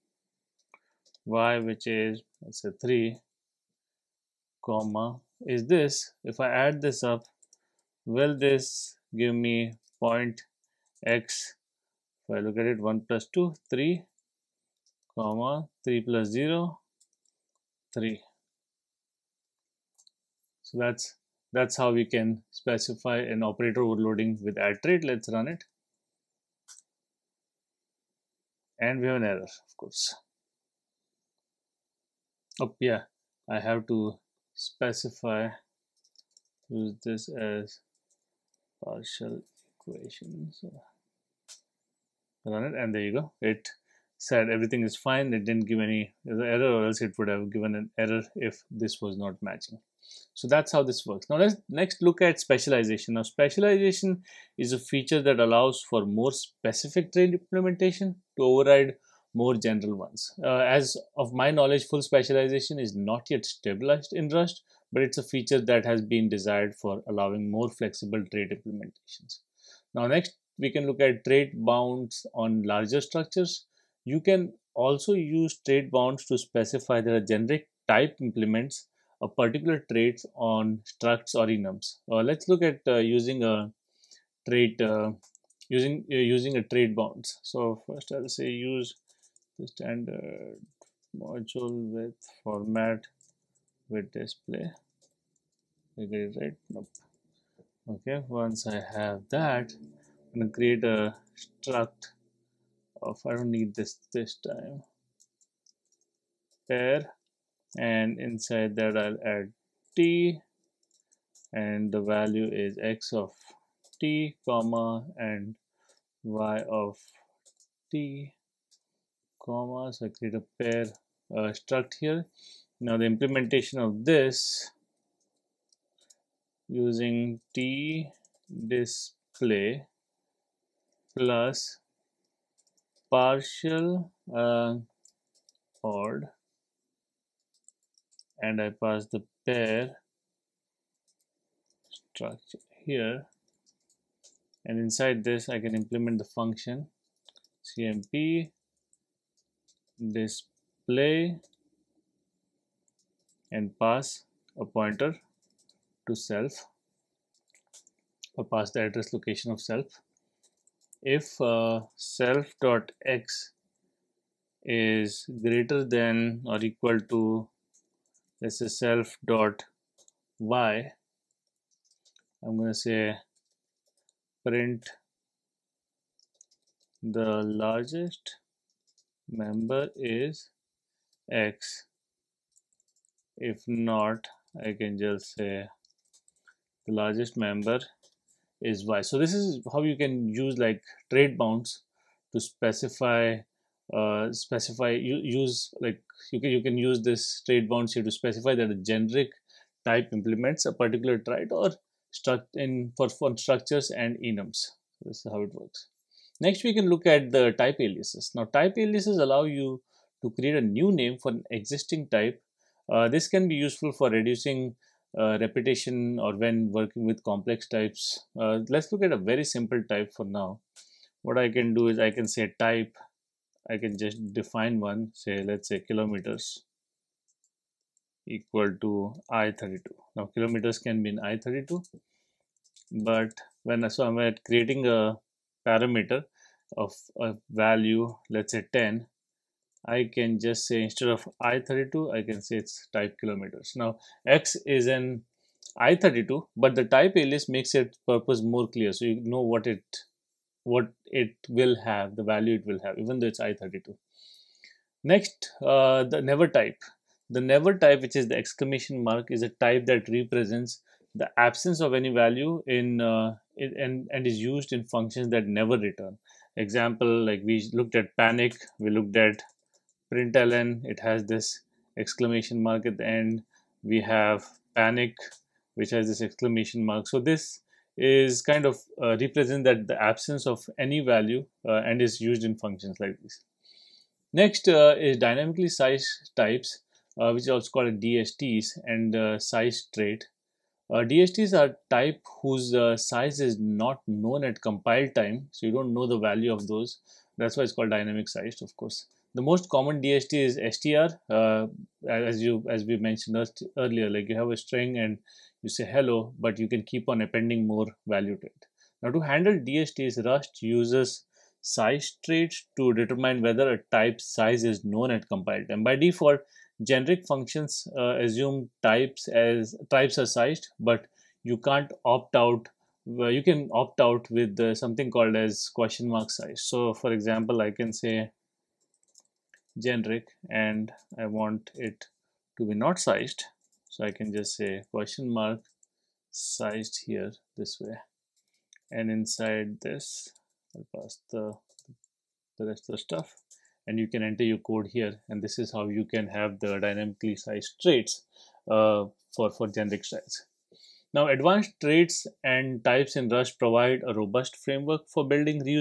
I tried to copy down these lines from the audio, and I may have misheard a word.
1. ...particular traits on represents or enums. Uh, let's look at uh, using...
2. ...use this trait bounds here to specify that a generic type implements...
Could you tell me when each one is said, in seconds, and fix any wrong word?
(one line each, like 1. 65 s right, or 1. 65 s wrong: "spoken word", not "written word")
1. 79 s wrong: "structs", not "represents"
2. 196 s right.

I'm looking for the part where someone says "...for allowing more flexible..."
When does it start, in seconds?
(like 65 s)
66 s.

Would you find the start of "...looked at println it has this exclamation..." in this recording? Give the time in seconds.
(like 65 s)
268 s.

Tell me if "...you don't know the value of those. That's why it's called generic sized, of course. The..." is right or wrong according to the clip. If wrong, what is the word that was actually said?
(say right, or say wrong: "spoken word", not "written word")
wrong: "dynamic", not "generic".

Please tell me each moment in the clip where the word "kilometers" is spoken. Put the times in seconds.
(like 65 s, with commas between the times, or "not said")
225 s, 230 s, 243 s.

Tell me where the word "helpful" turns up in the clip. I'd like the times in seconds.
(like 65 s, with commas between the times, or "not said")
not said.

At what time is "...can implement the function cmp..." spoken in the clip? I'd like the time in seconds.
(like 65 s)
145 s.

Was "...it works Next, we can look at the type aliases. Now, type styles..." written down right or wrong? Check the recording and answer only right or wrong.
wrong.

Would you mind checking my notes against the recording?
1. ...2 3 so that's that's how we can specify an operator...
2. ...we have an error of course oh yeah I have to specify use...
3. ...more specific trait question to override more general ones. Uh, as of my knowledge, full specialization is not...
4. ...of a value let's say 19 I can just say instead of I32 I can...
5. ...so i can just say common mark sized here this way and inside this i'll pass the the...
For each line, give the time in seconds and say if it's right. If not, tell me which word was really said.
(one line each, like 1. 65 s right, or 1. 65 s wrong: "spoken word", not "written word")
1. 16 s wrong: "0", not "2"
2. 29 s right
3. 56 s wrong: "implementation", not "question"
4. 236 s wrong: "10", not "19"
5. 333 s wrong: "question", not "common".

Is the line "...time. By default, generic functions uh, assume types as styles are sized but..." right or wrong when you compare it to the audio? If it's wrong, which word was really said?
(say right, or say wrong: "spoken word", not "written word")
wrong: "types", not "styles".